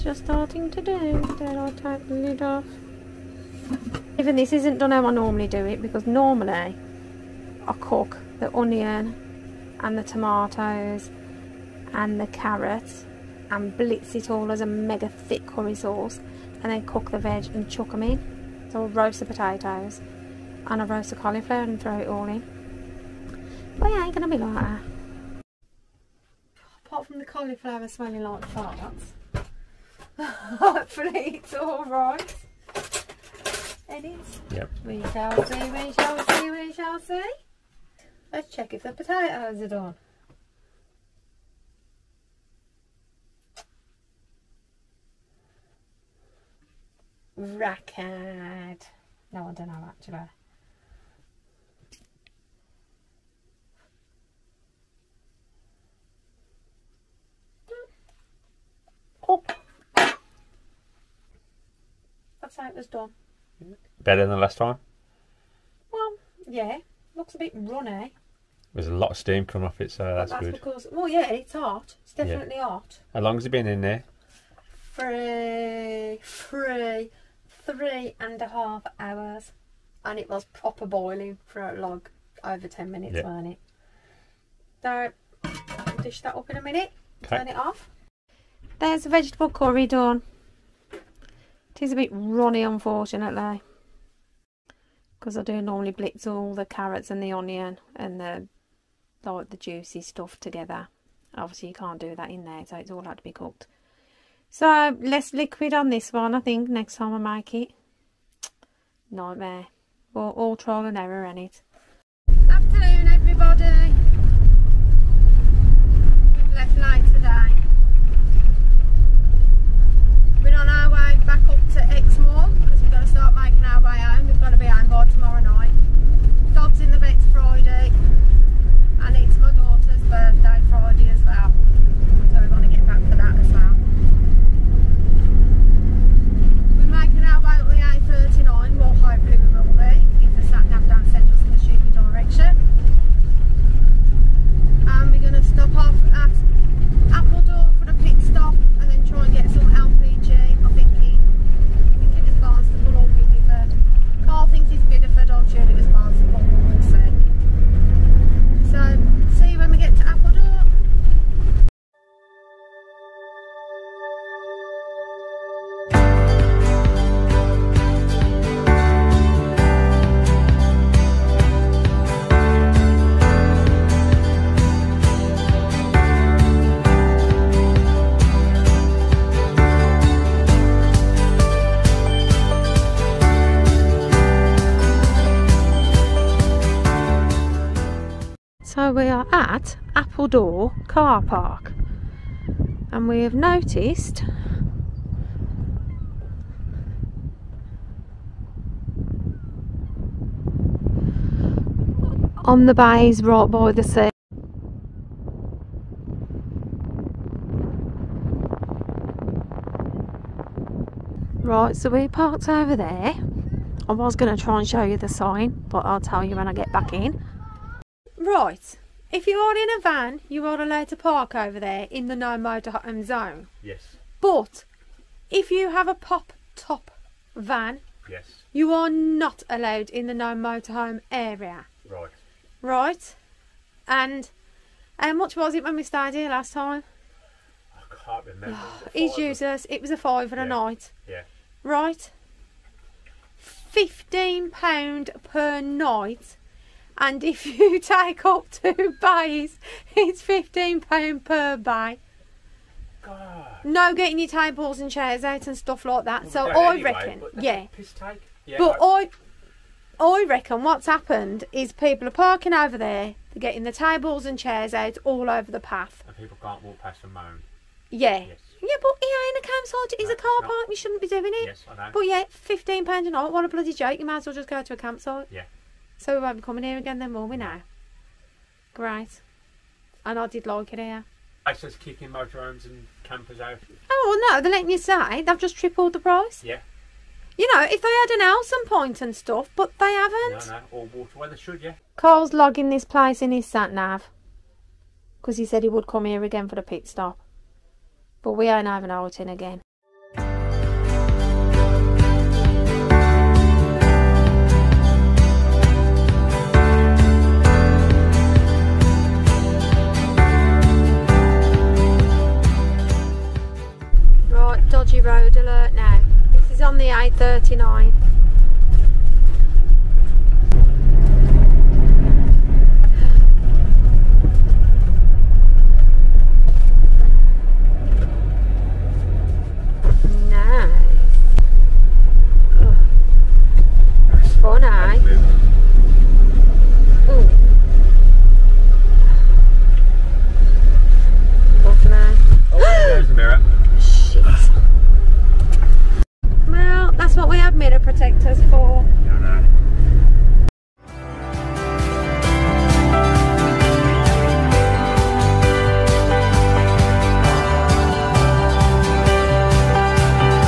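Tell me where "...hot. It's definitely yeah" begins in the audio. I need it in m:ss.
1:11.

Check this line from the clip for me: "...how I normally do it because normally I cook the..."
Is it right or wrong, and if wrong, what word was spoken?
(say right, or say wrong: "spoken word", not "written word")
right.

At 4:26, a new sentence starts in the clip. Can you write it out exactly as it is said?
And people can't walk past and moan.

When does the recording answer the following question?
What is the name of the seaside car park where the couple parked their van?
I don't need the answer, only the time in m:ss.
3:09.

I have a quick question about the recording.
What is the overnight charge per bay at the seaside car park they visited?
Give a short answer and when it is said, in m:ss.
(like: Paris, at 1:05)
£15, at 4:10.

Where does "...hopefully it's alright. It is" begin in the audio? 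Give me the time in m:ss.
0:30.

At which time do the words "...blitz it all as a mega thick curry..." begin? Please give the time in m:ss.
0:13.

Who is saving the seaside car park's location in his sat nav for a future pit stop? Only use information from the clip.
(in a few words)
Karl.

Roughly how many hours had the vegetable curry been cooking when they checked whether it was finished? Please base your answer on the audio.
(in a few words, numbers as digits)
3.5.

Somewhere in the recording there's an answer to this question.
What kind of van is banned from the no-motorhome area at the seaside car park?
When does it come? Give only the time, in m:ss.
3:45.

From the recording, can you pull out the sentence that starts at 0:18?
So I'll roast the potatoes and I'll roast the cauliflower and throw it all in.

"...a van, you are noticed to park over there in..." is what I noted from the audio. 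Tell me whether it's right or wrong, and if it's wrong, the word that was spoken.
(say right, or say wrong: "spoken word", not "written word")
wrong: "allowed", not "noticed".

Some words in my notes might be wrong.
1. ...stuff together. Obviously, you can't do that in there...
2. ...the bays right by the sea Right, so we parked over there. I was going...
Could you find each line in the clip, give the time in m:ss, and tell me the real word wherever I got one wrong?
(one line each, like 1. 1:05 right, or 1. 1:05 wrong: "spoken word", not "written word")
1. 1:40 right
2. 3:22 right.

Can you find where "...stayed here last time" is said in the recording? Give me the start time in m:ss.
3:55.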